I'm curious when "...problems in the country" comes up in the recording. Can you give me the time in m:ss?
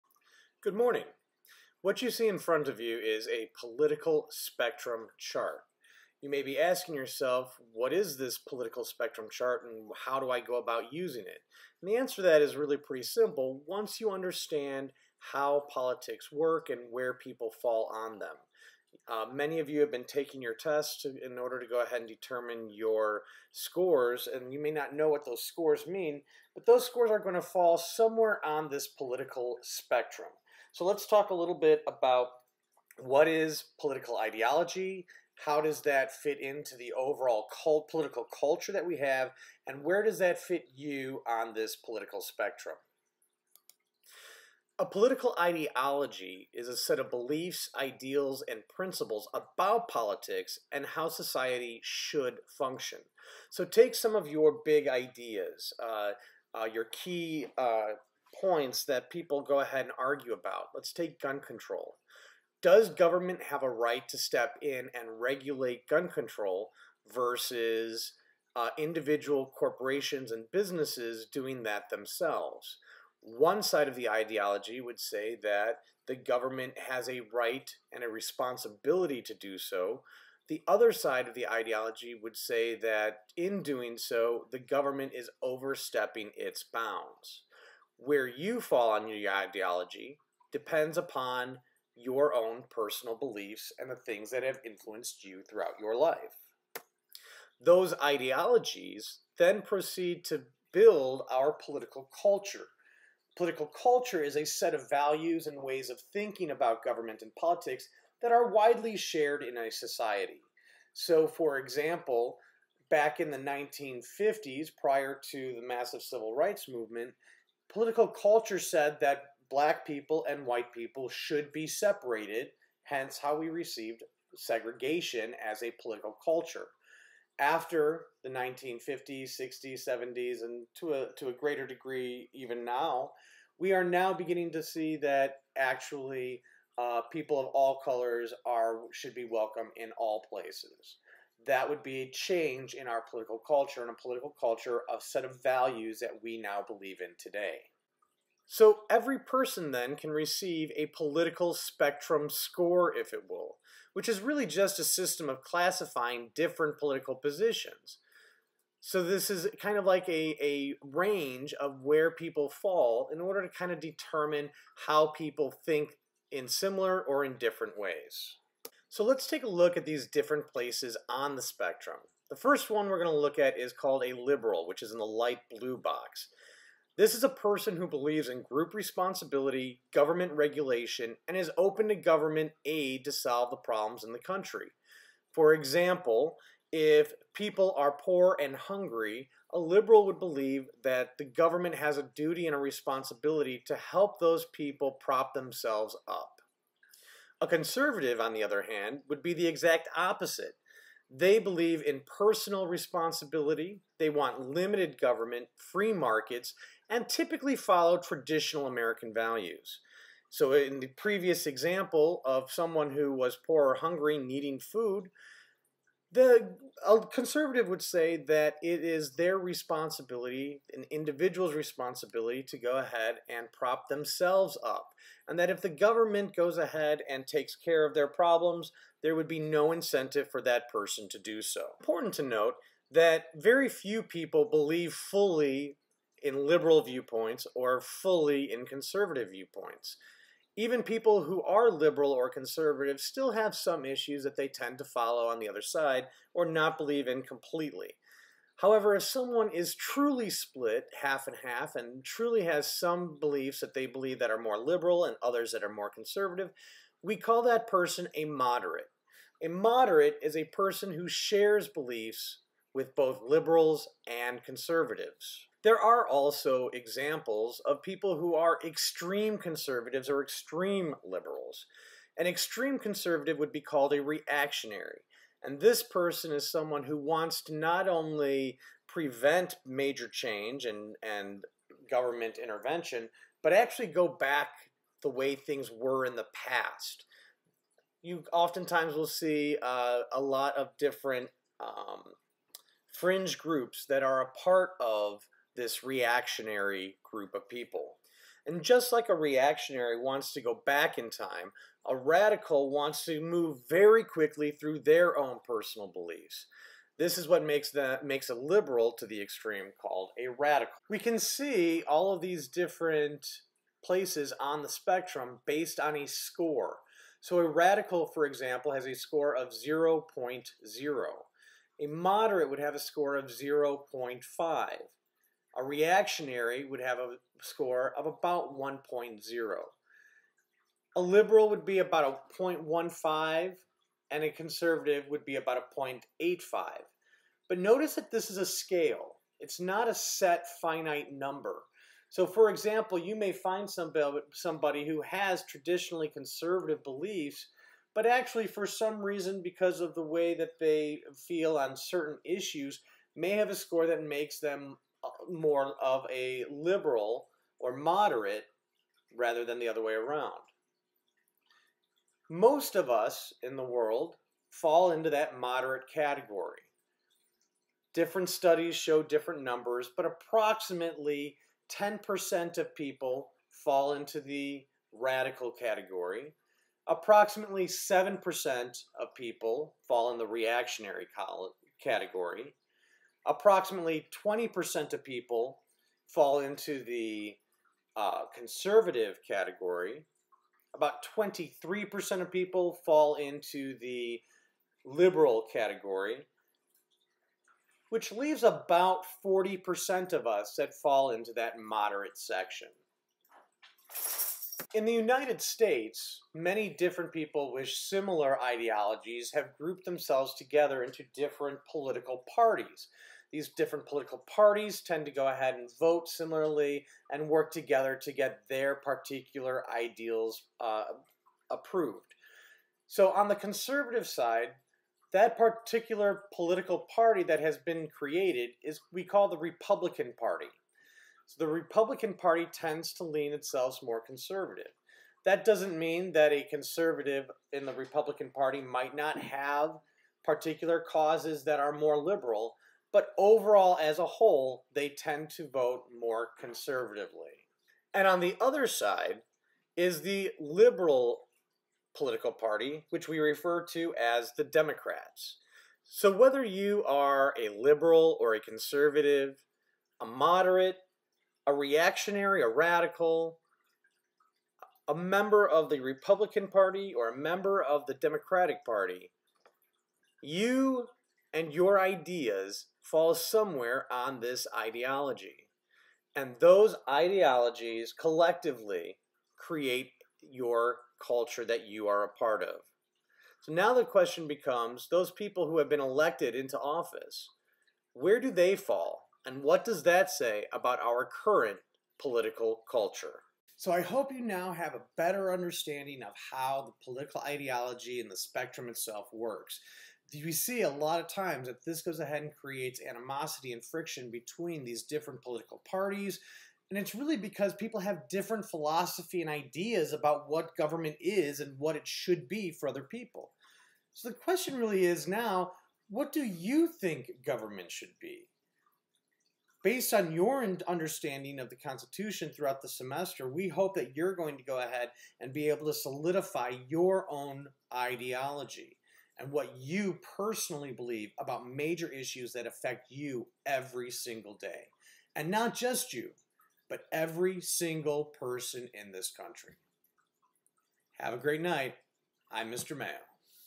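3:03.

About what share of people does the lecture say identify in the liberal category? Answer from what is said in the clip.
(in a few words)
23%.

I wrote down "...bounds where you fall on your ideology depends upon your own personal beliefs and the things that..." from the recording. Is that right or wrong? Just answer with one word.
right.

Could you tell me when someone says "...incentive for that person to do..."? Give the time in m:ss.
3:49.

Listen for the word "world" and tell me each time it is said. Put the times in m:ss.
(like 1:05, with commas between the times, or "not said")
6:03.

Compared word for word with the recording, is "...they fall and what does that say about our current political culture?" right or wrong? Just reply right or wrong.
right.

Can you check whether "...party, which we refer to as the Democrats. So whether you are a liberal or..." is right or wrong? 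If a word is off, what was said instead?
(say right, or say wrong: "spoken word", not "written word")
right.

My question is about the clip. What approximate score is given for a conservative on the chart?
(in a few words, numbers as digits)
0.85.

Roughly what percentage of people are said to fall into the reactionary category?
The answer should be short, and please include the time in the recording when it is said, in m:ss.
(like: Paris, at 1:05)
7%, at 6:17.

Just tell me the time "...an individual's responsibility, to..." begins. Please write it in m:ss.
3:40.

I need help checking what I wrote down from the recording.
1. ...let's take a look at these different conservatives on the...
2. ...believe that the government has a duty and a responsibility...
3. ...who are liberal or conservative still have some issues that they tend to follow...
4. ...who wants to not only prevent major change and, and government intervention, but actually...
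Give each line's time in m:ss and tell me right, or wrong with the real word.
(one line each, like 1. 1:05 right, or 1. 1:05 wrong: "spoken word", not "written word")
1. 2:49 wrong: "places", not "conservatives"
2. 3:10 right
3. 4:01 right
4. 4:36 right.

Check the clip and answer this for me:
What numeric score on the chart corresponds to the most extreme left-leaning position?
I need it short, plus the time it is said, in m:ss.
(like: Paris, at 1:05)
0.0, at 5:19.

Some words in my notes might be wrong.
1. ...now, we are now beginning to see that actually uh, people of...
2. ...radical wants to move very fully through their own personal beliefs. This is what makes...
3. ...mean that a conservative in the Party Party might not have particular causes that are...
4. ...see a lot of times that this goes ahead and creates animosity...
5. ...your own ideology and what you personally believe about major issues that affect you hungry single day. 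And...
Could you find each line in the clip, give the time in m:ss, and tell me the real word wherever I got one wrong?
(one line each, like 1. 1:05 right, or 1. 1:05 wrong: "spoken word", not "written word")
1. 2:12 right
2. 5:01 wrong: "quickly", not "fully"
3. 7:15 wrong: "Republican", not "Party"
4. 8:20 right
5. 8:46 wrong: "every", not "hungry".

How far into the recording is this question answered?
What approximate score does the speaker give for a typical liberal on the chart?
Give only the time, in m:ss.
5:32.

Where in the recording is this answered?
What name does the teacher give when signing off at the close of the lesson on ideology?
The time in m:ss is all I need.
9:02.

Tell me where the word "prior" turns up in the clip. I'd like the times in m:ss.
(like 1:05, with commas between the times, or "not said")
1:54.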